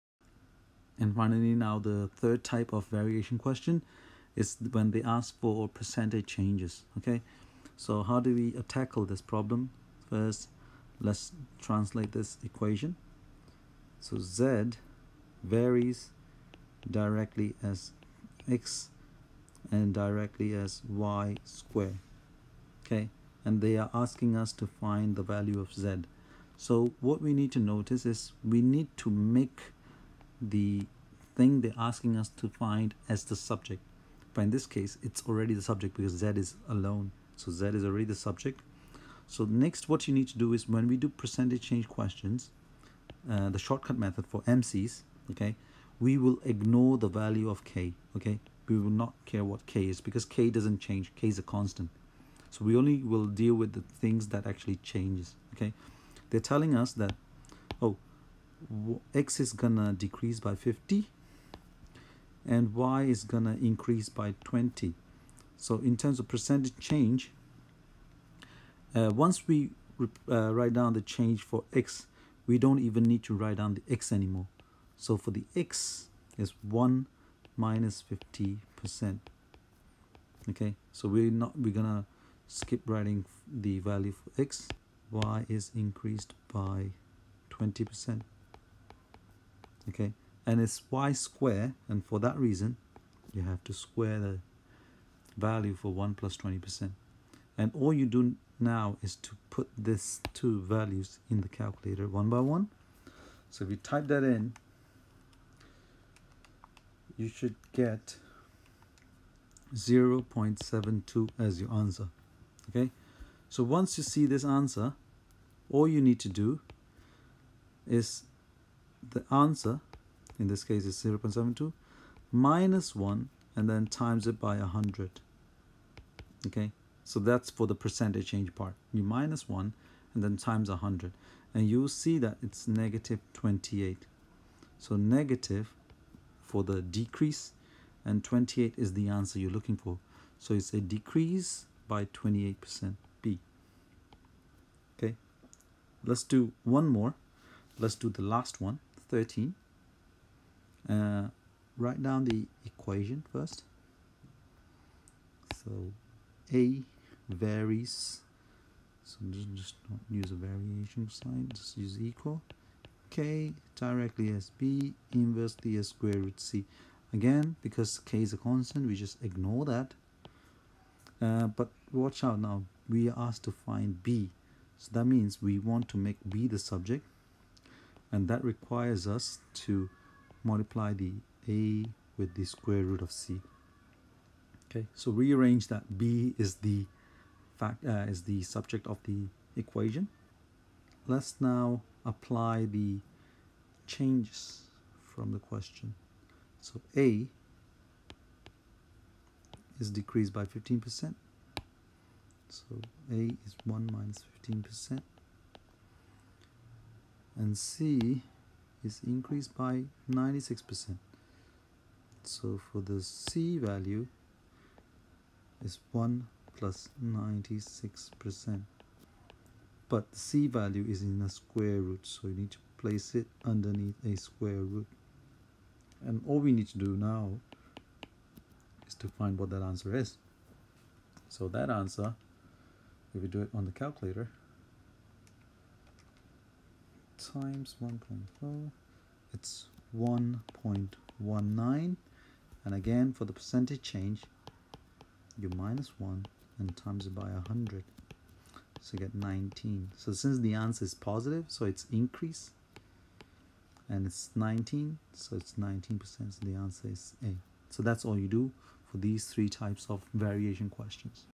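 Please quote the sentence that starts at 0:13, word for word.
So Z varies directly as X and directly as Y square, okay?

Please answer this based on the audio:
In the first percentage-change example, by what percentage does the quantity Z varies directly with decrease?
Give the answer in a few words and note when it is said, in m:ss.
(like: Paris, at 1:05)
50%, at 0:59.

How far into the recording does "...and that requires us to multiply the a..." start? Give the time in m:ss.
2:58.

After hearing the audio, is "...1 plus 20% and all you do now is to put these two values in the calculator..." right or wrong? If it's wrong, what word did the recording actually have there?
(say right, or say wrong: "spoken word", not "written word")
right.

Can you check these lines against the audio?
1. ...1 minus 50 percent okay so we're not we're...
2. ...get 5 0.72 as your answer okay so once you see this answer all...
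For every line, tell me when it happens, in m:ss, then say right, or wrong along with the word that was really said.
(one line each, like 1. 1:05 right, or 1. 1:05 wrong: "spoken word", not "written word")
1. 1:16 right
2. 1:47 wrong: "0", not "5".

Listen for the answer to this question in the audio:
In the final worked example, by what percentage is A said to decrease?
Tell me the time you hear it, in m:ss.
3:19.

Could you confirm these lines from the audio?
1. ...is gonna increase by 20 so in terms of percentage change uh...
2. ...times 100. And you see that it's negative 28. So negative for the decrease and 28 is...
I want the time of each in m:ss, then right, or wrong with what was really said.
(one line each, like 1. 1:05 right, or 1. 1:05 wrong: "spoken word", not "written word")
1. 1:03 right
2. 2:10 right.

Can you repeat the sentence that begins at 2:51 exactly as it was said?
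Uh, but watch out now, we are asked to find B.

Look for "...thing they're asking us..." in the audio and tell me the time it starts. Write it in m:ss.
0:31.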